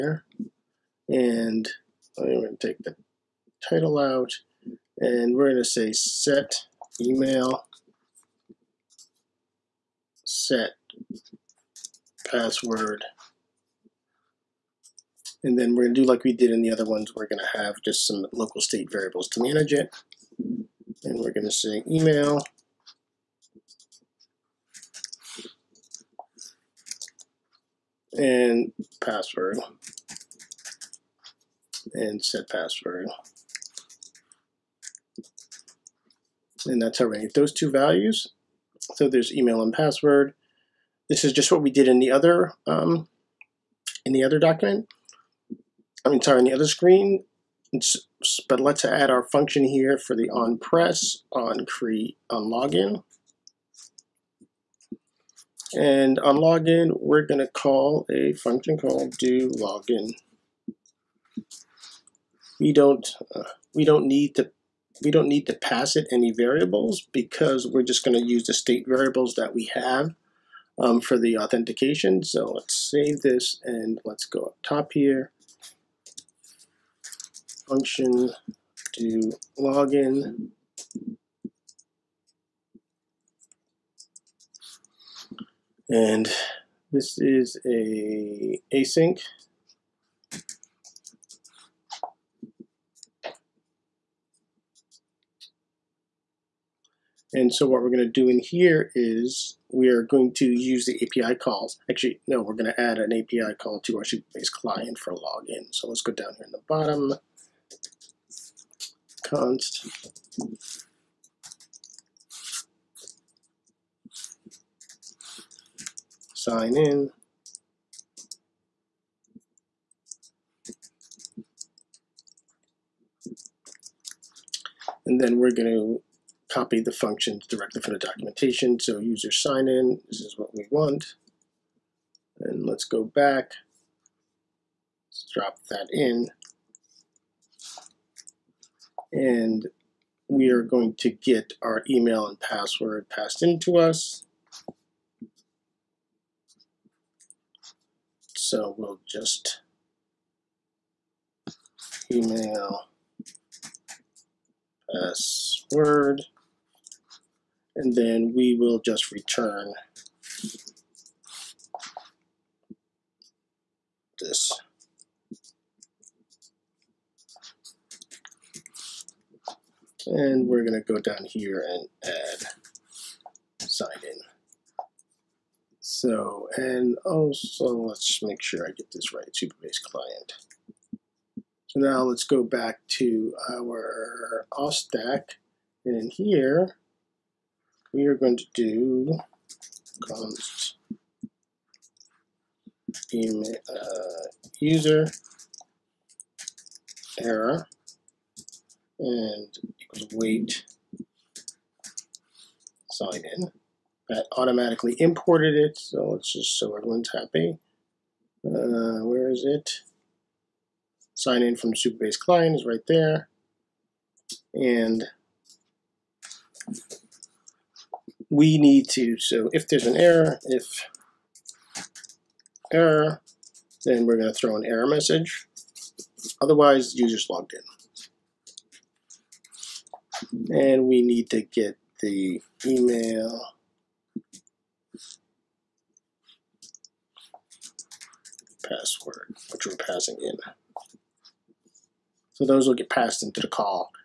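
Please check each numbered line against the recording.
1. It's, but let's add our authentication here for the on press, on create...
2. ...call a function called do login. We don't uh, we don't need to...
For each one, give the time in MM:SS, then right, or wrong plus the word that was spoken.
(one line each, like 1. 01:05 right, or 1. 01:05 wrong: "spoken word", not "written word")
1. 00:47 wrong: "function", not "authentication"
2. 00:57 right.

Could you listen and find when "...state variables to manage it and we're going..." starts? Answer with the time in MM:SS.
00:18.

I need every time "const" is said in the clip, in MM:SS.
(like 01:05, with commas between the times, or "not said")
01:49, 03:10.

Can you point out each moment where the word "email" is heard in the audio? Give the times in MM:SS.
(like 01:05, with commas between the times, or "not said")
00:07, 00:21, 00:39, 02:21, 02:32, 03:13, 03:52.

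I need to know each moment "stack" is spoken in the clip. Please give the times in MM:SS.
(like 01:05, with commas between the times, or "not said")
03:04.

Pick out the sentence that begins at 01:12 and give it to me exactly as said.
So let's save this and let's go up top here.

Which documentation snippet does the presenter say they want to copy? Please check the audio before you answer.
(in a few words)
user sign in.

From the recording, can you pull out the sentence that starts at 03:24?
That automatically imported it, so let's just so everyone's happy.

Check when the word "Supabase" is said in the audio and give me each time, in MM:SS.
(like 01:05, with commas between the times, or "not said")
01:44, 02:59, 03:31.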